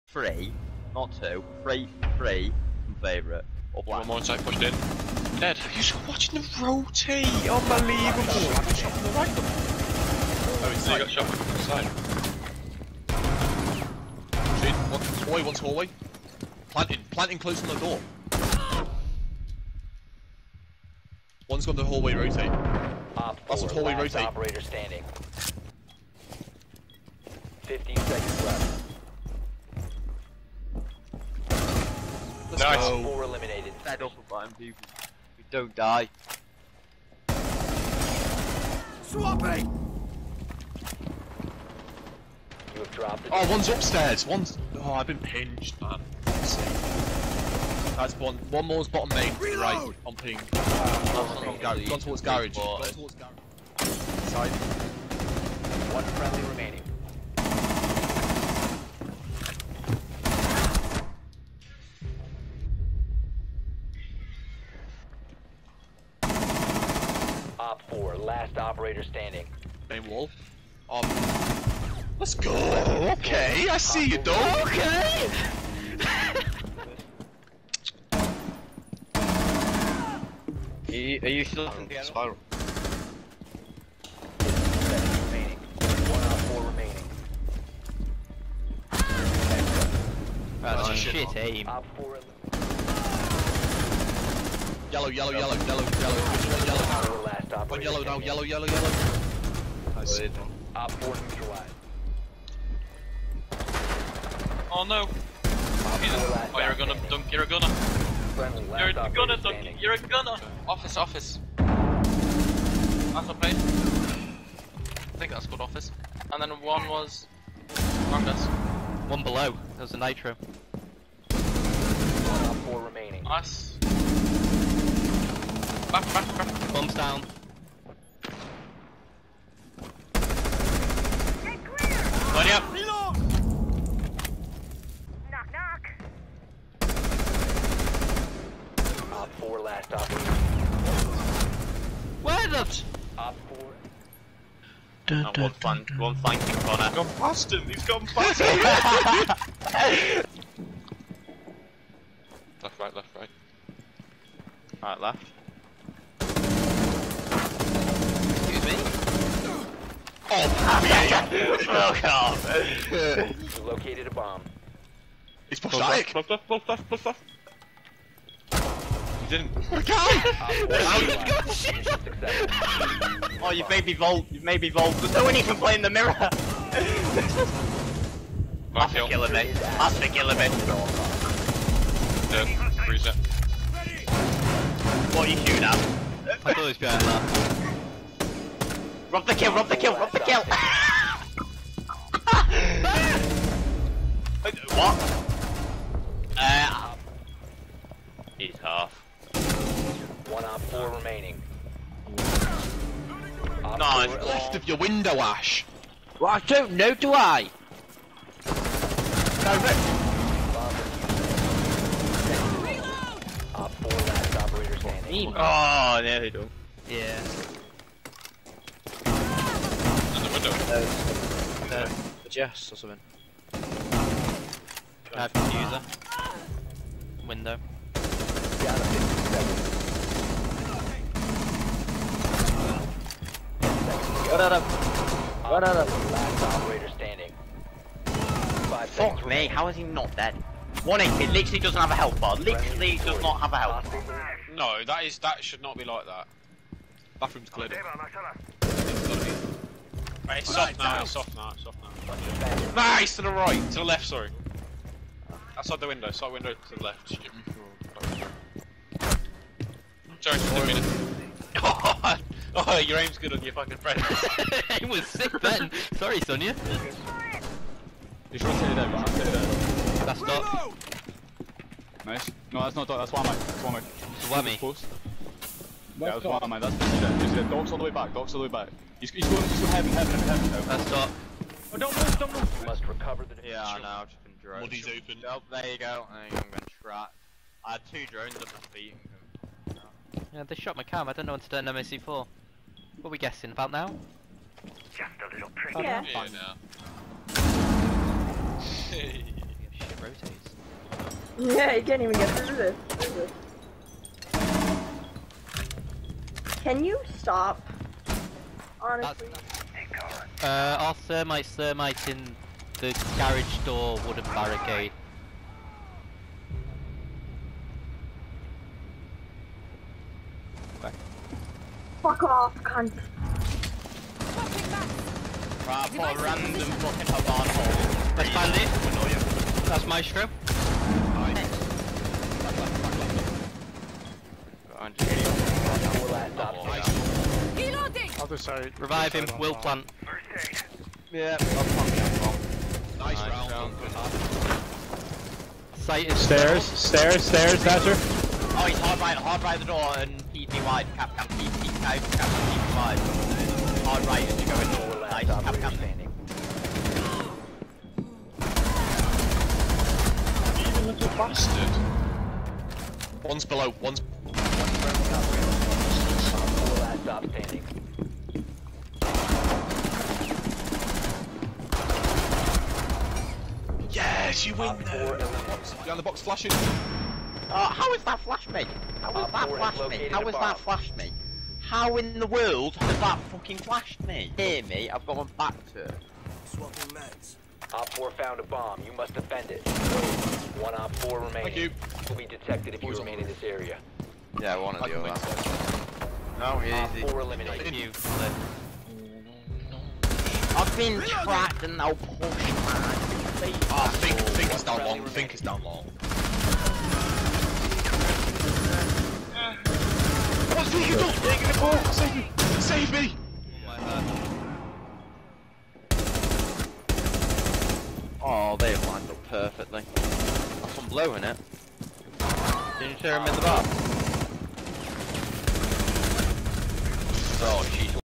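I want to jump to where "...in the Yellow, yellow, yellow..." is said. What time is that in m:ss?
1:32.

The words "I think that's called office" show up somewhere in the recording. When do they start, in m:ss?
1:54.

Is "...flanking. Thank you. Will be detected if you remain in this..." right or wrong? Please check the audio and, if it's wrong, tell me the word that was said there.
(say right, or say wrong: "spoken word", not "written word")
wrong: "remaining", not "flanking".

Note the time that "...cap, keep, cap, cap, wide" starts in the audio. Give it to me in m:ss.
5:51.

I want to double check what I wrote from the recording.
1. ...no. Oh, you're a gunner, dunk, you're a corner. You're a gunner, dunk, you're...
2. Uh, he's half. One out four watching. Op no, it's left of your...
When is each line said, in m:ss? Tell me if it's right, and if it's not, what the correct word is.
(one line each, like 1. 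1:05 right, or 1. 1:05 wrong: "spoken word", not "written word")
1. 1:44 wrong: "gunner", not "corner"
2. 3:16 wrong: "remaining", not "watching".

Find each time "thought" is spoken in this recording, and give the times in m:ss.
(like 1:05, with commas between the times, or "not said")
3:06.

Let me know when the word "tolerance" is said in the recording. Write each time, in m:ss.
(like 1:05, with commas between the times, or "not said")
not said.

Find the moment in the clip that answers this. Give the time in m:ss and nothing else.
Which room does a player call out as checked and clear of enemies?
4:07.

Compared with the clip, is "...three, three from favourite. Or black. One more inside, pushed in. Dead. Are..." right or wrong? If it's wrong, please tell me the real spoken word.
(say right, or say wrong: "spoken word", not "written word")
right.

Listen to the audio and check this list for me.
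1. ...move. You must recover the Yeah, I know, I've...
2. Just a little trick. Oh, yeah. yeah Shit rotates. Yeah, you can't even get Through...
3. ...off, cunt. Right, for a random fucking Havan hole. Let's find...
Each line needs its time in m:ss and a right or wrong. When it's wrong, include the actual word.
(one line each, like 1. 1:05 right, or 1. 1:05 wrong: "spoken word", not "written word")
1. 4:42 right
2. 4:54 right
3. 5:22 right.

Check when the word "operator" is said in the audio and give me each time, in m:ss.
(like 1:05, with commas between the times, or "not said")
0:24, 1:08, 2:19, 3:34, 3:56.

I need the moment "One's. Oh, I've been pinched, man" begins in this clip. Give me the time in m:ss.
0:44.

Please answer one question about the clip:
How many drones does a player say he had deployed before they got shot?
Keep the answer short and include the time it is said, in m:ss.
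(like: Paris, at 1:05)
2, at 4:47.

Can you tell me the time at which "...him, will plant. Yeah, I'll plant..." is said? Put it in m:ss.
5:39.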